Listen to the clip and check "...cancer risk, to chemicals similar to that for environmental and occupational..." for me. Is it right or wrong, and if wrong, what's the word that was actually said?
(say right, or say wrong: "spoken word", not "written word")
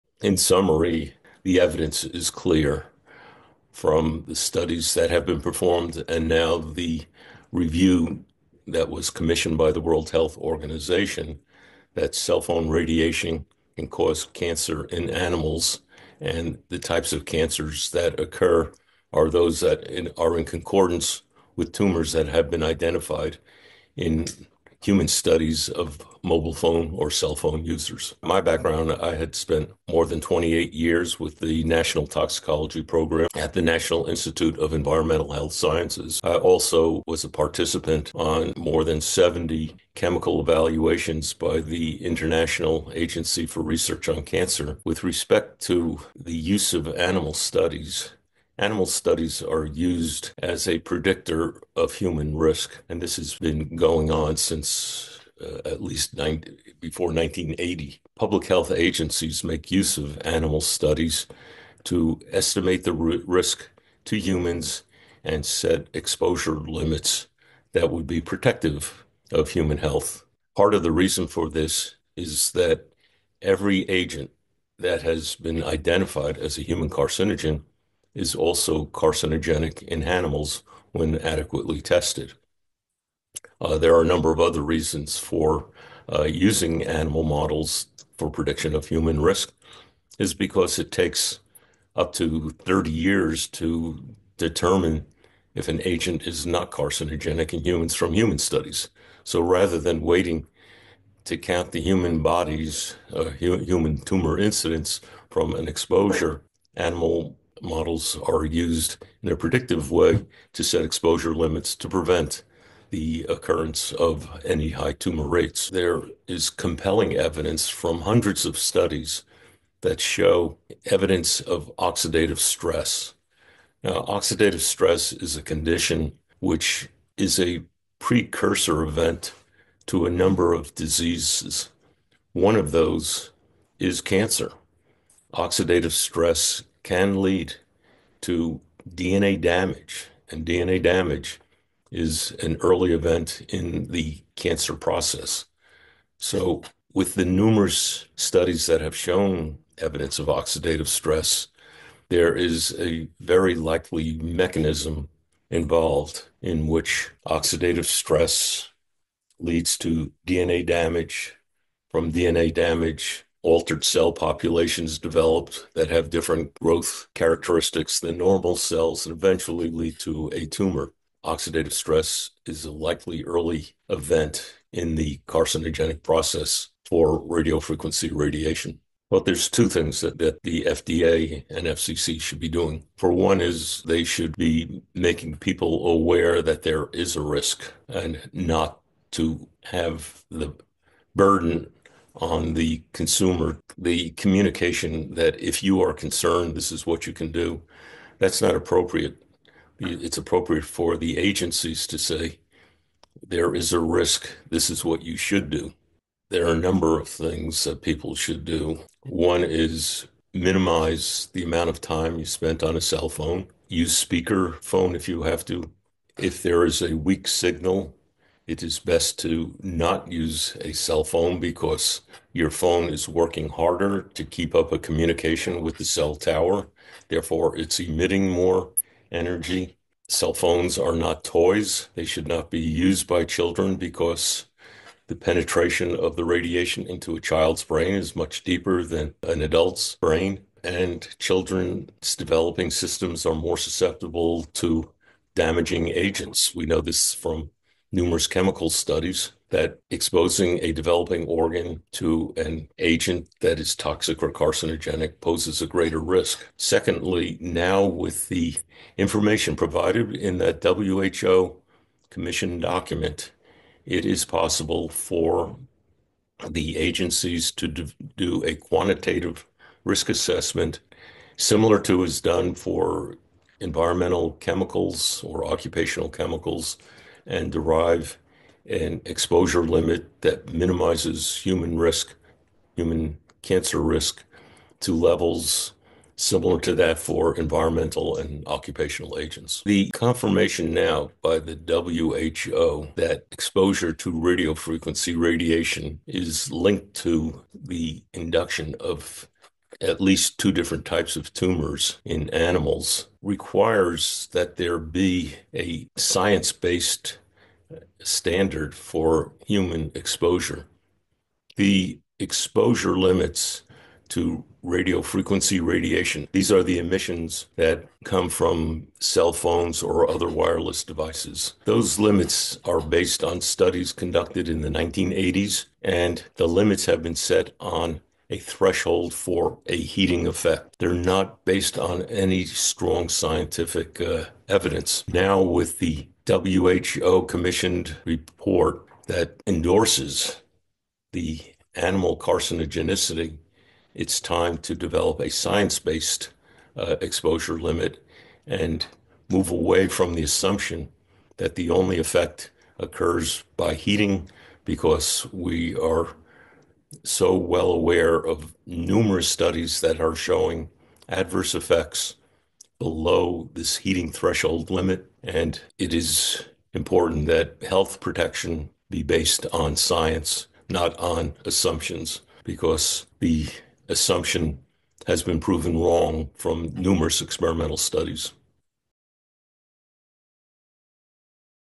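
wrong: "levels", not "chemicals".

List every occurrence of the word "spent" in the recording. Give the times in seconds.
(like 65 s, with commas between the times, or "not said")
29 s, 212 s.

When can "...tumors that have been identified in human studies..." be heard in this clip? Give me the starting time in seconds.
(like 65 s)
21 s.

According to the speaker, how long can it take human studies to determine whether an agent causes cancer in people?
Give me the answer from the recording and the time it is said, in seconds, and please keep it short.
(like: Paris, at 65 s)
up to 30 years, at 91 s.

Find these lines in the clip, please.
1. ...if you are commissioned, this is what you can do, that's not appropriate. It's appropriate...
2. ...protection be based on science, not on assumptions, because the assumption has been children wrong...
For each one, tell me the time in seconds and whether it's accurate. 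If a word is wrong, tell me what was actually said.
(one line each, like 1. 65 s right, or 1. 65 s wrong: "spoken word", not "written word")
1. 195 s wrong: "concerned", not "commissioned"
2. 367 s wrong: "proven", not "children".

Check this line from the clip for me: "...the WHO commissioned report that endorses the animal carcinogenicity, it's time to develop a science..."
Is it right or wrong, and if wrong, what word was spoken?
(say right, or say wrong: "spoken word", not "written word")
right.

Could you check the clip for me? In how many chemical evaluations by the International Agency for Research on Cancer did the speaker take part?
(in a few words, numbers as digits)
more than 70.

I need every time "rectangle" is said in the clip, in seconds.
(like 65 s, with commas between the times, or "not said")
not said.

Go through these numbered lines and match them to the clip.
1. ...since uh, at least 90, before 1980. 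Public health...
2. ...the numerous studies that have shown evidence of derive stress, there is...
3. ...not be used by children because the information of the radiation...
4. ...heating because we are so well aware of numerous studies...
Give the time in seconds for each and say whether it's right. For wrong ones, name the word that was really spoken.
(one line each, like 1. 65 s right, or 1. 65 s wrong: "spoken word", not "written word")
1. 54 s right
2. 147 s wrong: "oxidative", not "derive"
3. 232 s wrong: "penetration", not "information"
4. 353 s right.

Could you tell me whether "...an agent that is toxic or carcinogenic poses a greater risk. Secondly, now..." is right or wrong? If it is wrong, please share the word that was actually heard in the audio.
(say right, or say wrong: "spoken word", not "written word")
right.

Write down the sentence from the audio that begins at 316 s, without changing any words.
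These are the emissions that come from cell phones or other wireless devices.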